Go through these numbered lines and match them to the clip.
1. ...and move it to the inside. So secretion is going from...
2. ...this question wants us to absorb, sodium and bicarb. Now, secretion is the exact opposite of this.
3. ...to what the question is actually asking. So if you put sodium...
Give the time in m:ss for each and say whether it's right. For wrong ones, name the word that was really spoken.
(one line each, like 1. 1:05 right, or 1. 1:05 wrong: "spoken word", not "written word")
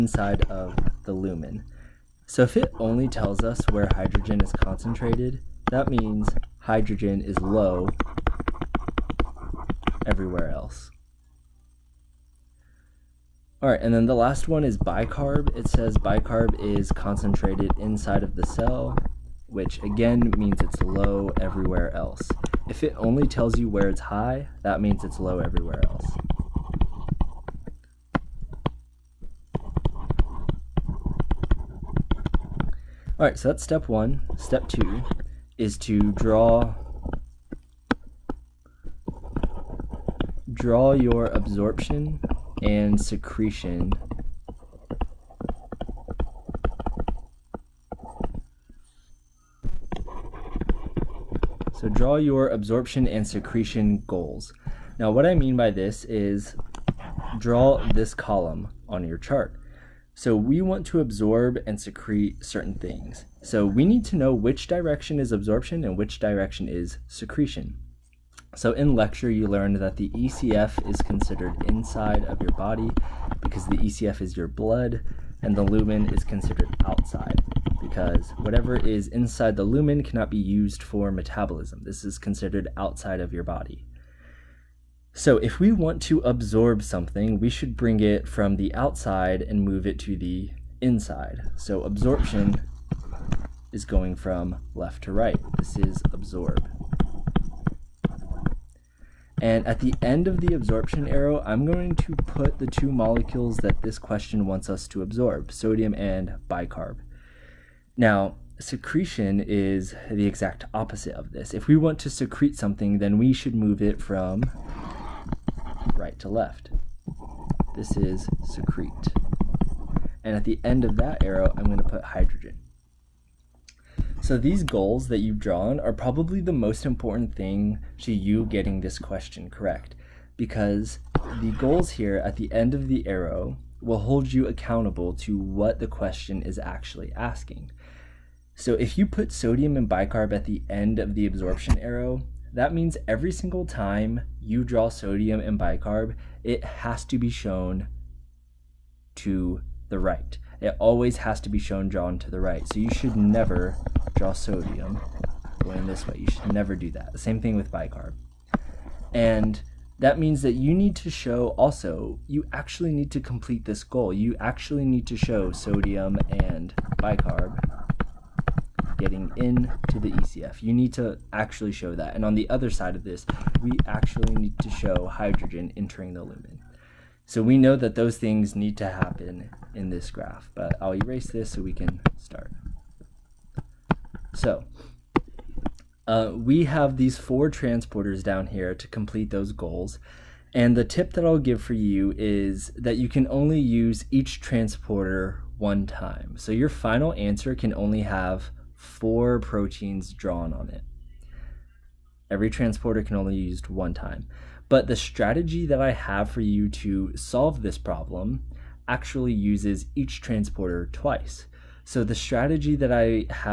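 1. 1:29 wrong: "absorption", not "secretion"
2. 1:43 right
3. 2:15 right.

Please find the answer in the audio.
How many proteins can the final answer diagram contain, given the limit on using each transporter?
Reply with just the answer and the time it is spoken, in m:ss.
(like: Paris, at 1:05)
4, at 3:18.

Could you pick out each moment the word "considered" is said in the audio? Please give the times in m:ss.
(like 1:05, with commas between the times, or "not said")
1:11, 1:16, 1:22.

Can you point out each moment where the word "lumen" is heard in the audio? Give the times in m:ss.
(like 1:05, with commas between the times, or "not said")
0:01, 1:15, 1:19, 2:56.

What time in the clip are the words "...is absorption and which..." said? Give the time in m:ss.
1:05.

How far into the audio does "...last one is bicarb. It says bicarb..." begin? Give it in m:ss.
0:14.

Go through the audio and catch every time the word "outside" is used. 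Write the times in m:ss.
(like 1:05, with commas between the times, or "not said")
1:16, 1:22, 1:28.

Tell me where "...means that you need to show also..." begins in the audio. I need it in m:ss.
2:40.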